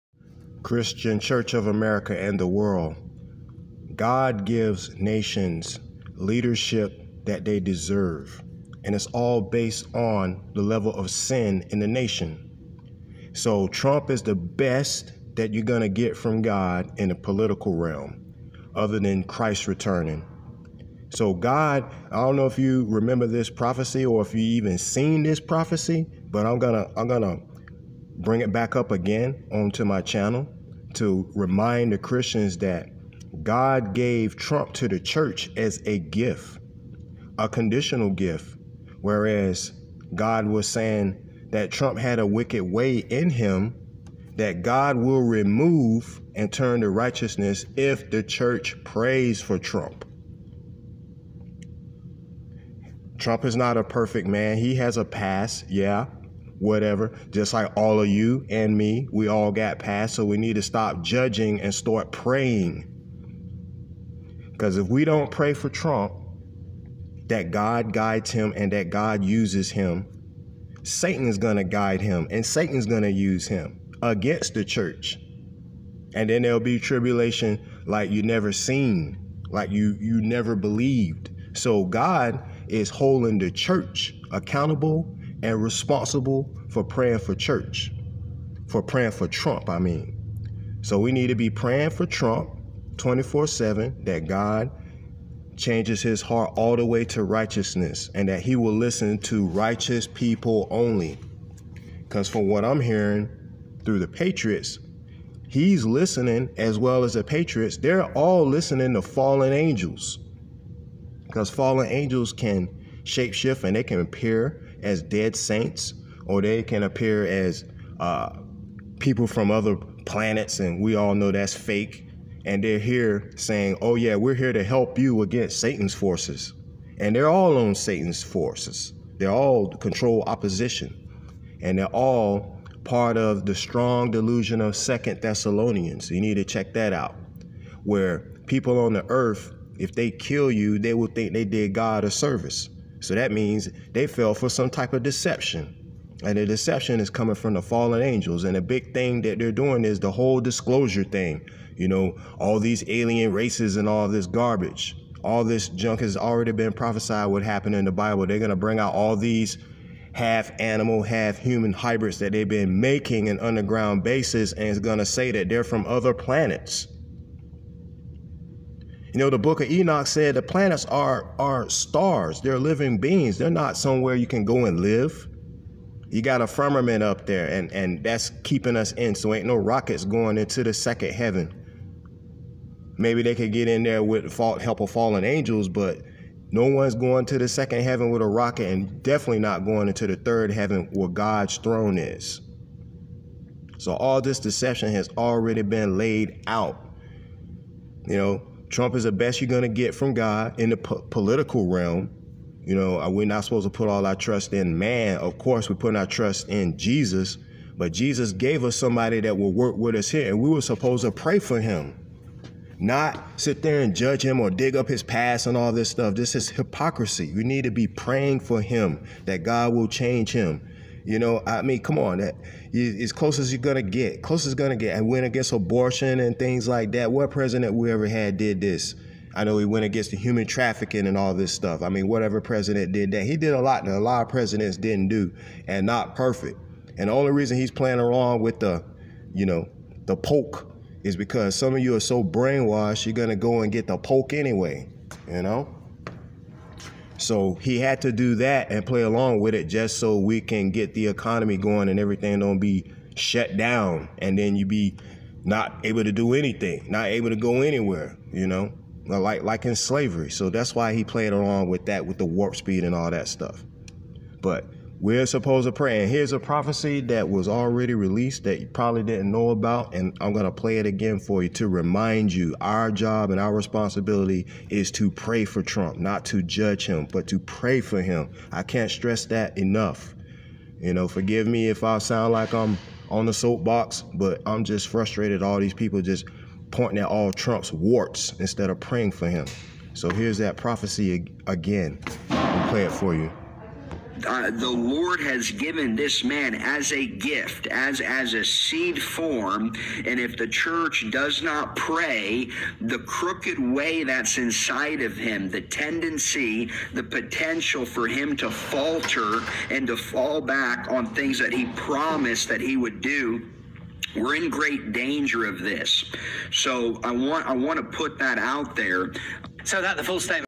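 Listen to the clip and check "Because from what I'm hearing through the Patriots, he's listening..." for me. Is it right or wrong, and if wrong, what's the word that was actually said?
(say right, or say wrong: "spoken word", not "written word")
right.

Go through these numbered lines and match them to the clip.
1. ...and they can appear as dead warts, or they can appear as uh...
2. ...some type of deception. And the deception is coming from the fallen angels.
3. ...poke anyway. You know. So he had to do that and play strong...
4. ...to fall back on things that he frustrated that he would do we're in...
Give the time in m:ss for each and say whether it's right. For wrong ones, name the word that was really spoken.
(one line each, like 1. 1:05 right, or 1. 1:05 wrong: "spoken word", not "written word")
1. 1:53 wrong: "saints", not "warts"
2. 2:24 right
3. 4:03 wrong: "along", not "strong"
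4. 5:09 wrong: "promised", not "frustrated".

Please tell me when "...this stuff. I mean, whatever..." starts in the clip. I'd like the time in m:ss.
3:51.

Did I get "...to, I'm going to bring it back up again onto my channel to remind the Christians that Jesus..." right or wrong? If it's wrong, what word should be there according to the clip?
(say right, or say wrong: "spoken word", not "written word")
wrong: "God", not "Jesus".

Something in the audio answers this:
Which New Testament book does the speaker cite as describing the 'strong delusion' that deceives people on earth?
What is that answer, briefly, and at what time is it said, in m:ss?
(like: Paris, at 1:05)
Second Thessalonians, at 2:14.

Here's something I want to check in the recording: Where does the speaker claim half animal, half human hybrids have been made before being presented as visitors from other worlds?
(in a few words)
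Underground bases.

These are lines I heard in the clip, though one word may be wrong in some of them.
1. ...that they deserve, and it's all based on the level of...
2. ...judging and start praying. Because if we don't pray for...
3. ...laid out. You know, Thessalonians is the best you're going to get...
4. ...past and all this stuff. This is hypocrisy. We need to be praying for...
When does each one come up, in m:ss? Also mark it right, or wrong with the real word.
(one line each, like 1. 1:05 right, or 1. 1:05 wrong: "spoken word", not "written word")
1. 0:07 right
2. 1:01 right
3. 3:15 wrong: "Trump", not "Thessalonians"
4. 3:35 right.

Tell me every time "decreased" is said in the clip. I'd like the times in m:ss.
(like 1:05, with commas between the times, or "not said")
not said.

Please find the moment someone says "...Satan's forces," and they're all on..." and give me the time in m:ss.
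2:05.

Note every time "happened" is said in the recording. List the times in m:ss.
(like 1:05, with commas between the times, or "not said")
2:37.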